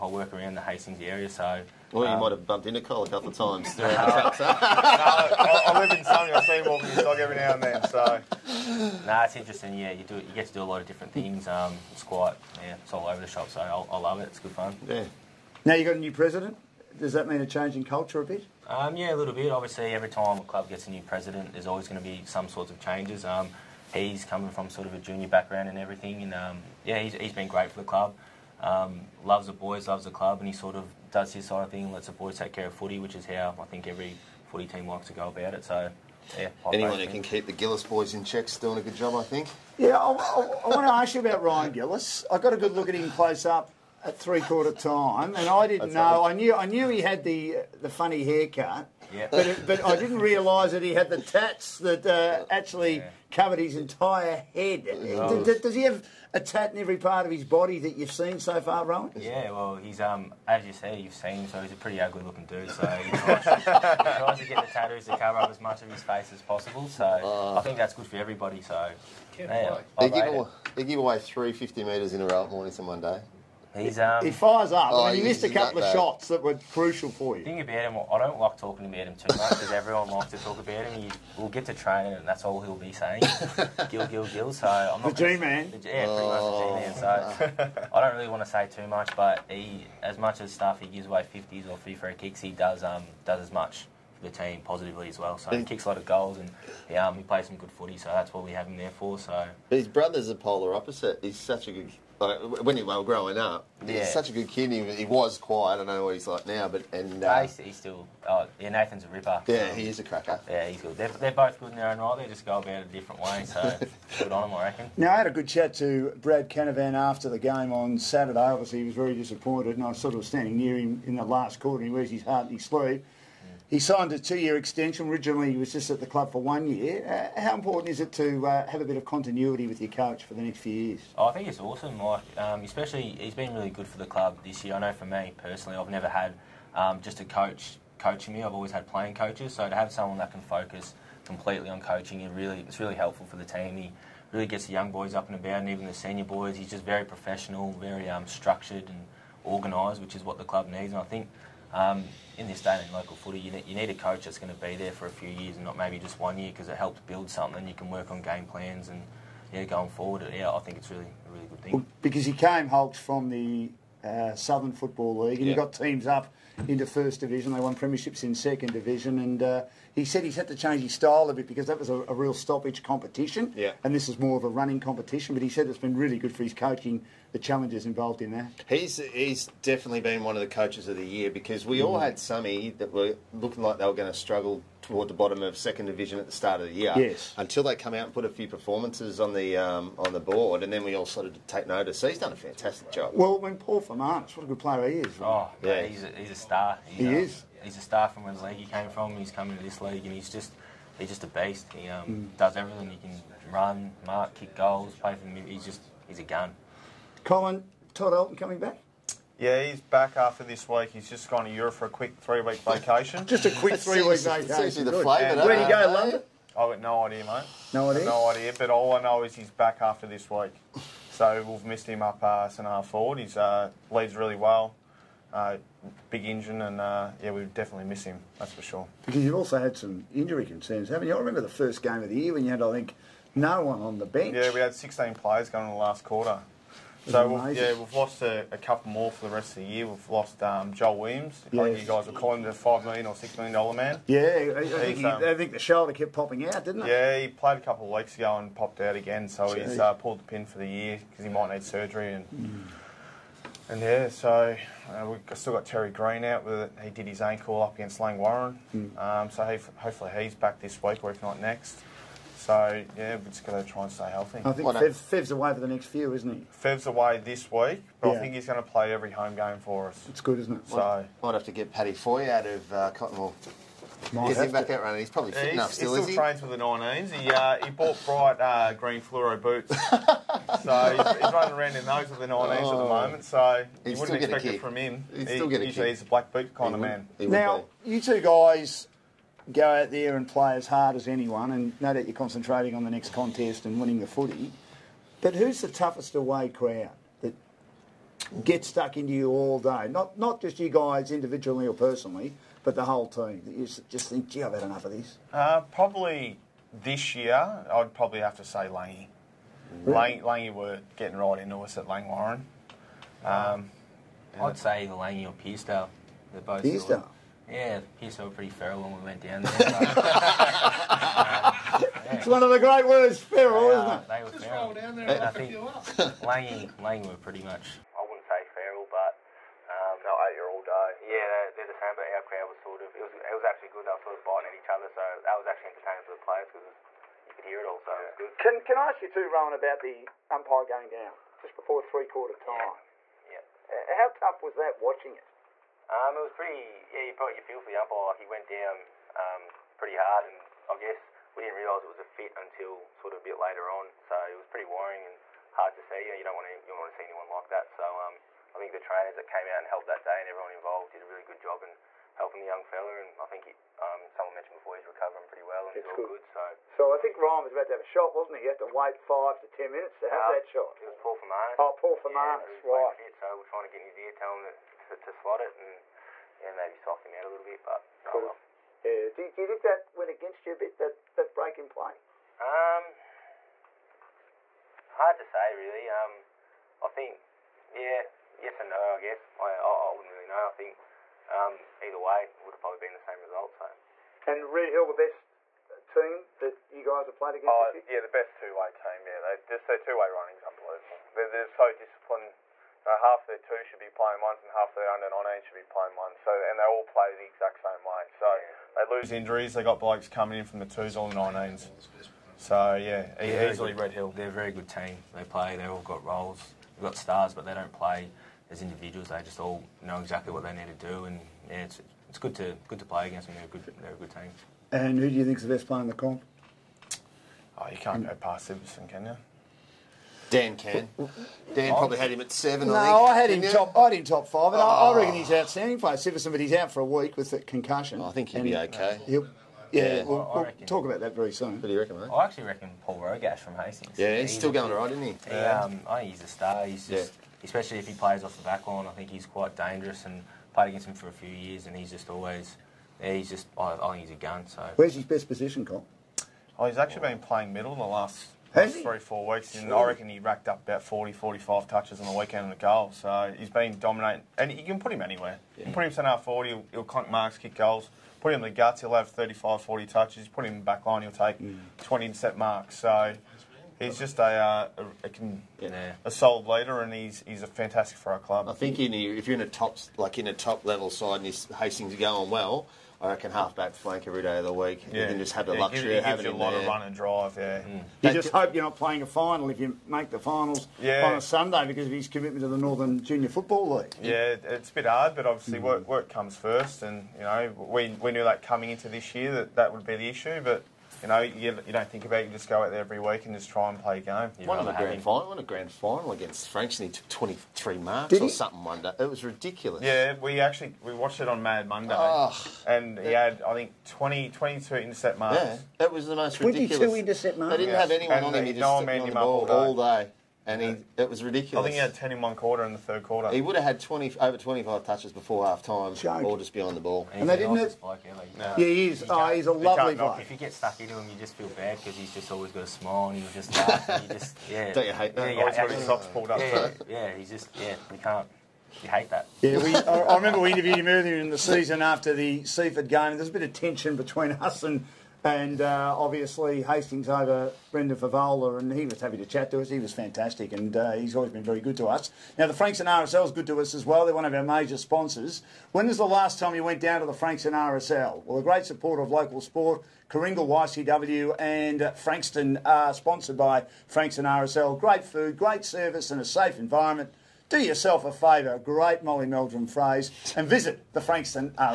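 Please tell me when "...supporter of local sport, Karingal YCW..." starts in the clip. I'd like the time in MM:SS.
09:18.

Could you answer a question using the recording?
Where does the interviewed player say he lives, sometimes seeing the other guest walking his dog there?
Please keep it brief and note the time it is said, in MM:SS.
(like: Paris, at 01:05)
Sunny, at 00:06.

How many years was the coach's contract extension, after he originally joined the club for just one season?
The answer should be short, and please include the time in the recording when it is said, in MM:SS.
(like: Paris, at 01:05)
2, at 02:04.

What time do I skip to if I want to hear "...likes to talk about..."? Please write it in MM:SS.
01:20.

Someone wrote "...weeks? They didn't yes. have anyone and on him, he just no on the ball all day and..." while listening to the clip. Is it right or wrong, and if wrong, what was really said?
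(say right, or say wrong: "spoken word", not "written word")
wrong: "marks", not "weeks".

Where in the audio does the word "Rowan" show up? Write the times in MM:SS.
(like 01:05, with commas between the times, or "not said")
00:58, 05:39.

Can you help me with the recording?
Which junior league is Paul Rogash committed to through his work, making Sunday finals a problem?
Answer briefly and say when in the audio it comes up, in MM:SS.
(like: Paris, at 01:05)
Northern Junior Football League, at 08:12.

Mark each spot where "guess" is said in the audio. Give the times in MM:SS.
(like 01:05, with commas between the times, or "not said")
05:50, 06:28.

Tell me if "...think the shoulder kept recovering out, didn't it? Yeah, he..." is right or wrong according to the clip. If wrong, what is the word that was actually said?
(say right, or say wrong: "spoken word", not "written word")
wrong: "popping", not "recovering".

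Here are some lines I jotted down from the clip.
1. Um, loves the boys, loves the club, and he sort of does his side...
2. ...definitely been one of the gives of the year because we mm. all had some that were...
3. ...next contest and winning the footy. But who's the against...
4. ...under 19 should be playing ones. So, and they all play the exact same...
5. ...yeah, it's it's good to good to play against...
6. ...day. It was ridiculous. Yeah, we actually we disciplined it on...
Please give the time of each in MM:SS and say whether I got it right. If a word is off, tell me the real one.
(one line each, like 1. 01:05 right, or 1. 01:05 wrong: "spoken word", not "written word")
1. 00:28 right
2. 02:59 wrong: "coaches", not "gives"
3. 04:52 wrong: "toughest", not "against"
4. 06:44 right
5. 07:01 right
6. 08:28 wrong: "watched", not "disciplined".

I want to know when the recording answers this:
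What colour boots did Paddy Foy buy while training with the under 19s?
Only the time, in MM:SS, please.
04:38.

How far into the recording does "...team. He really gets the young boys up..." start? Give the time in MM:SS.
02:23.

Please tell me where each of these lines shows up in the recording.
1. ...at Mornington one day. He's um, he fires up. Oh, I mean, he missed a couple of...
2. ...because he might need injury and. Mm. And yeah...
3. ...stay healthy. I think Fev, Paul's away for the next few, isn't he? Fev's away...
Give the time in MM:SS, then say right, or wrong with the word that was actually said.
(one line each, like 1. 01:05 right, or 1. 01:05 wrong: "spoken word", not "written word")
1. 01:12 right
2. 04:11 wrong: "surgery", not "injury"
3. 04:23 wrong: "Fev", not "Paul".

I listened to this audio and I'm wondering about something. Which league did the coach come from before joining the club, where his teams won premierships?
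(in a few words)
Southern Football League.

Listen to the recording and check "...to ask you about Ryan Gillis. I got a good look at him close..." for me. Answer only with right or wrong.
right.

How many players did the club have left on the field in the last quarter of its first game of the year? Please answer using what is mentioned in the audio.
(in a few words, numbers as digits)
16.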